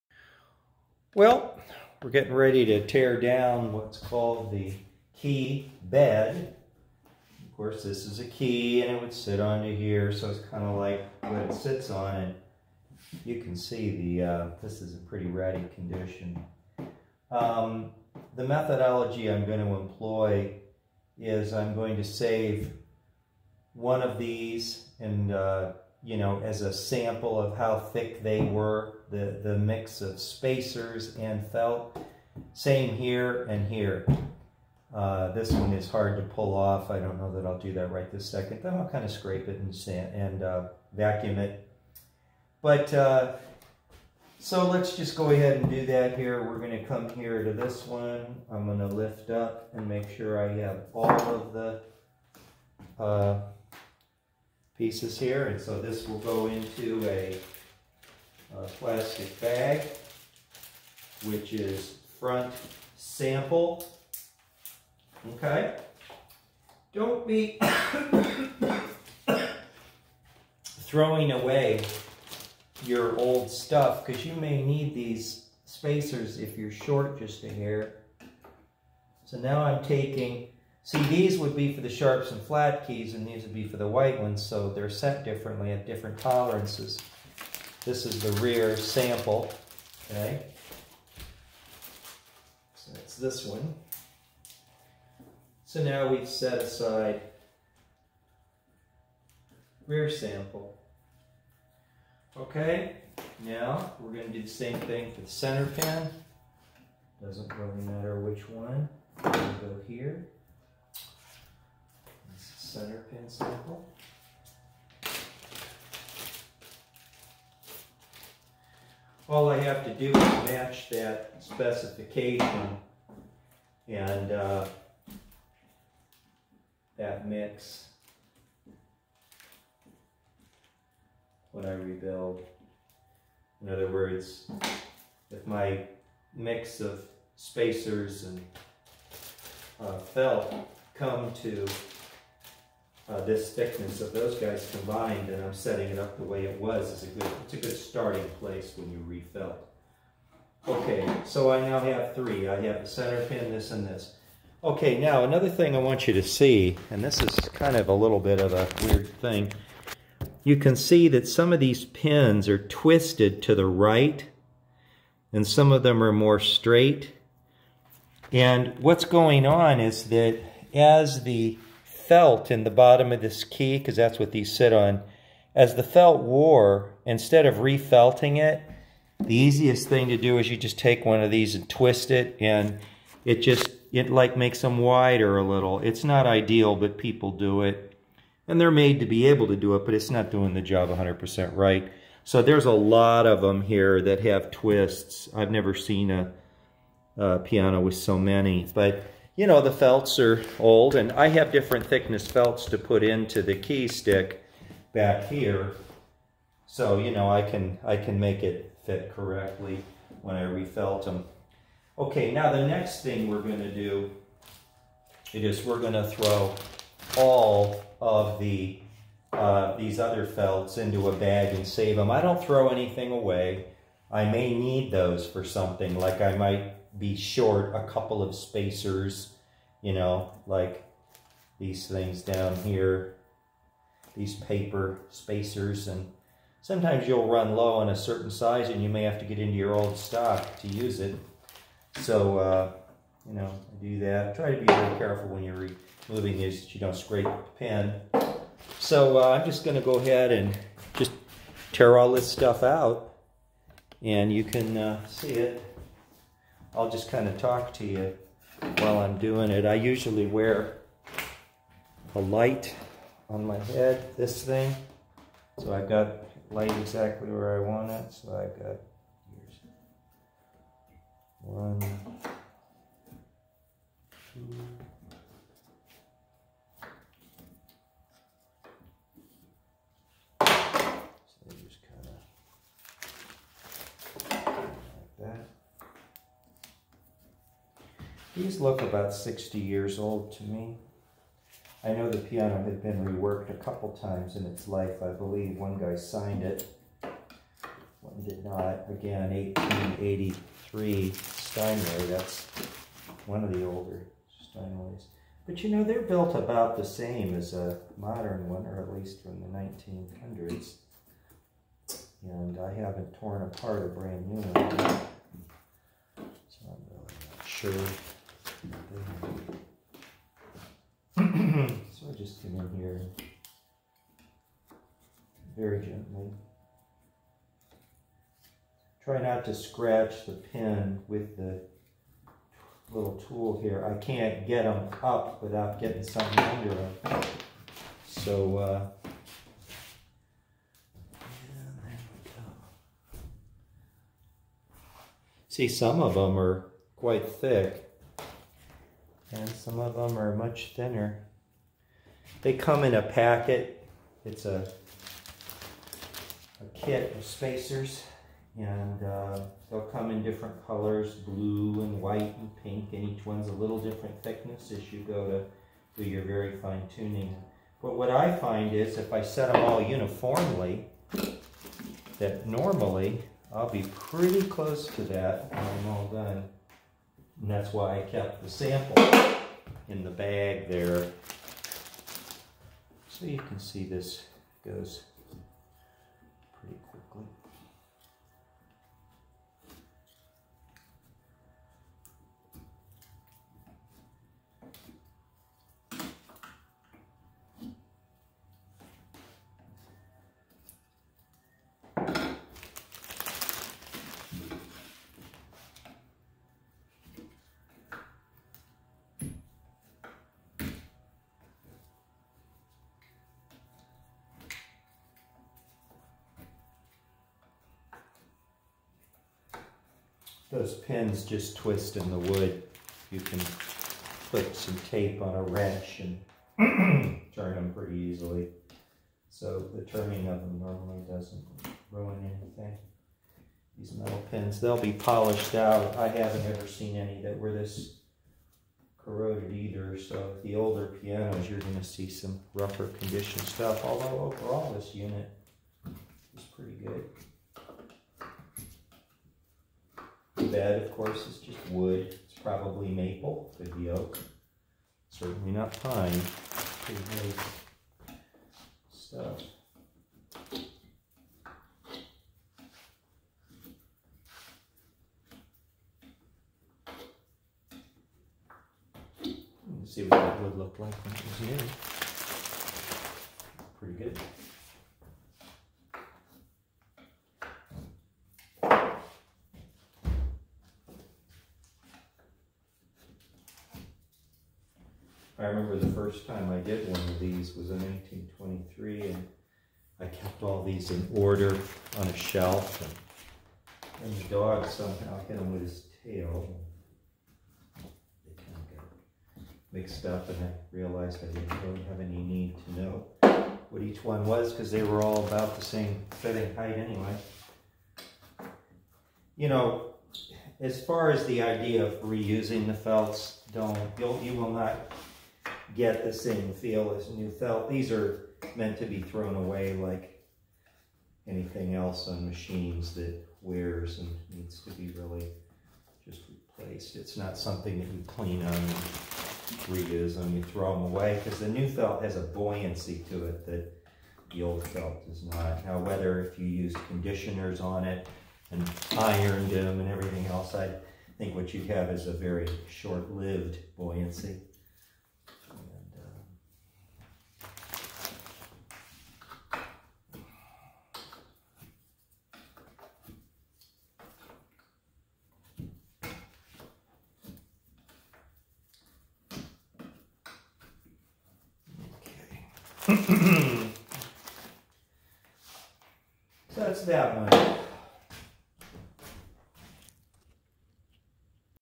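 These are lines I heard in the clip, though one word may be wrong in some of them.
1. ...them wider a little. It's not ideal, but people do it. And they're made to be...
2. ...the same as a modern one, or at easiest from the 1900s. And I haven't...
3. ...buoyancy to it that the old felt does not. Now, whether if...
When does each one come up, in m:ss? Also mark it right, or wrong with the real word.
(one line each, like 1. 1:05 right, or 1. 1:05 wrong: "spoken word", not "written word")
1. 3:04 right
2. 5:06 wrong: "least", not "easiest"
3. 8:52 right.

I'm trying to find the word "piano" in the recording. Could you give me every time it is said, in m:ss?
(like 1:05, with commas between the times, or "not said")
3:17, 4:52, 7:21.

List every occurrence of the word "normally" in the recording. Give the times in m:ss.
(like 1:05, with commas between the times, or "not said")
6:12, 7:10.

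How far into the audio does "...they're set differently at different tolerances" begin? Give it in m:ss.
1:24.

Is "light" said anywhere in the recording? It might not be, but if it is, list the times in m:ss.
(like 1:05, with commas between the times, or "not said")
4:22, 4:26.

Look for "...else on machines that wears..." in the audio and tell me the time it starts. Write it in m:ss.
8:41.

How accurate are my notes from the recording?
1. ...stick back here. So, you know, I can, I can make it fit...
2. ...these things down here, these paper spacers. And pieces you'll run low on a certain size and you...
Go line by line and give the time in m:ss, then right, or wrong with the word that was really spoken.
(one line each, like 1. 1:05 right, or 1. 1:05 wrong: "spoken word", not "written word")
1. 3:23 right
2. 3:51 wrong: "sometimes", not "pieces".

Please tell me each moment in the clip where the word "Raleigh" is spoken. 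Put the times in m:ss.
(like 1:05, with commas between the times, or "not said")
not said.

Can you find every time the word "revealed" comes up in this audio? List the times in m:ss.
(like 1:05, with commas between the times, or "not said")
not said.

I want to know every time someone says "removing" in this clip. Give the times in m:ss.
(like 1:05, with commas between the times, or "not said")
4:06.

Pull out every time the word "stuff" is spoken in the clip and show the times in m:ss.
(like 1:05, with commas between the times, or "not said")
1:13, 4:12, 7:23, 7:38.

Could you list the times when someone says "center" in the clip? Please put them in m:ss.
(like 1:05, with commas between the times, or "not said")
1:45, 1:52, 2:32.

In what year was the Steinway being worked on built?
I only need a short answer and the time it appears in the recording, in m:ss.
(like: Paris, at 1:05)
1883, at 4:59.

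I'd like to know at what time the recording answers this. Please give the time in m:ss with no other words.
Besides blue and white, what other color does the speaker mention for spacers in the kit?
6:02.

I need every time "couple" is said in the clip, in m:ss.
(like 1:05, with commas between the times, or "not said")
3:47, 4:53.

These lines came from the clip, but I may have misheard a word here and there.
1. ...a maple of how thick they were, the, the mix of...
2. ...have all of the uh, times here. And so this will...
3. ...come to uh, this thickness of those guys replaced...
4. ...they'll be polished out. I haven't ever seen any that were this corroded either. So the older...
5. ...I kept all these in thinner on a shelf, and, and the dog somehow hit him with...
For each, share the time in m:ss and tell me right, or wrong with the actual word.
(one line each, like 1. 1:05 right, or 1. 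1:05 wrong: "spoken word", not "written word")
1. 0:26 wrong: "sample", not "maple"
2. 0:50 wrong: "pieces", not "times"
3. 2:20 wrong: "combined", not "replaced"
4. 7:14 right
5. 8:09 wrong: "order", not "thinner".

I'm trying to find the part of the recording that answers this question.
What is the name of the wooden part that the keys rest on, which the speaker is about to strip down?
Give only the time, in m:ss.
0:05.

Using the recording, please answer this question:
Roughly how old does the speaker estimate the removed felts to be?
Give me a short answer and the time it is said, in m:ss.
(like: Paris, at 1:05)
60 years, at 4:49.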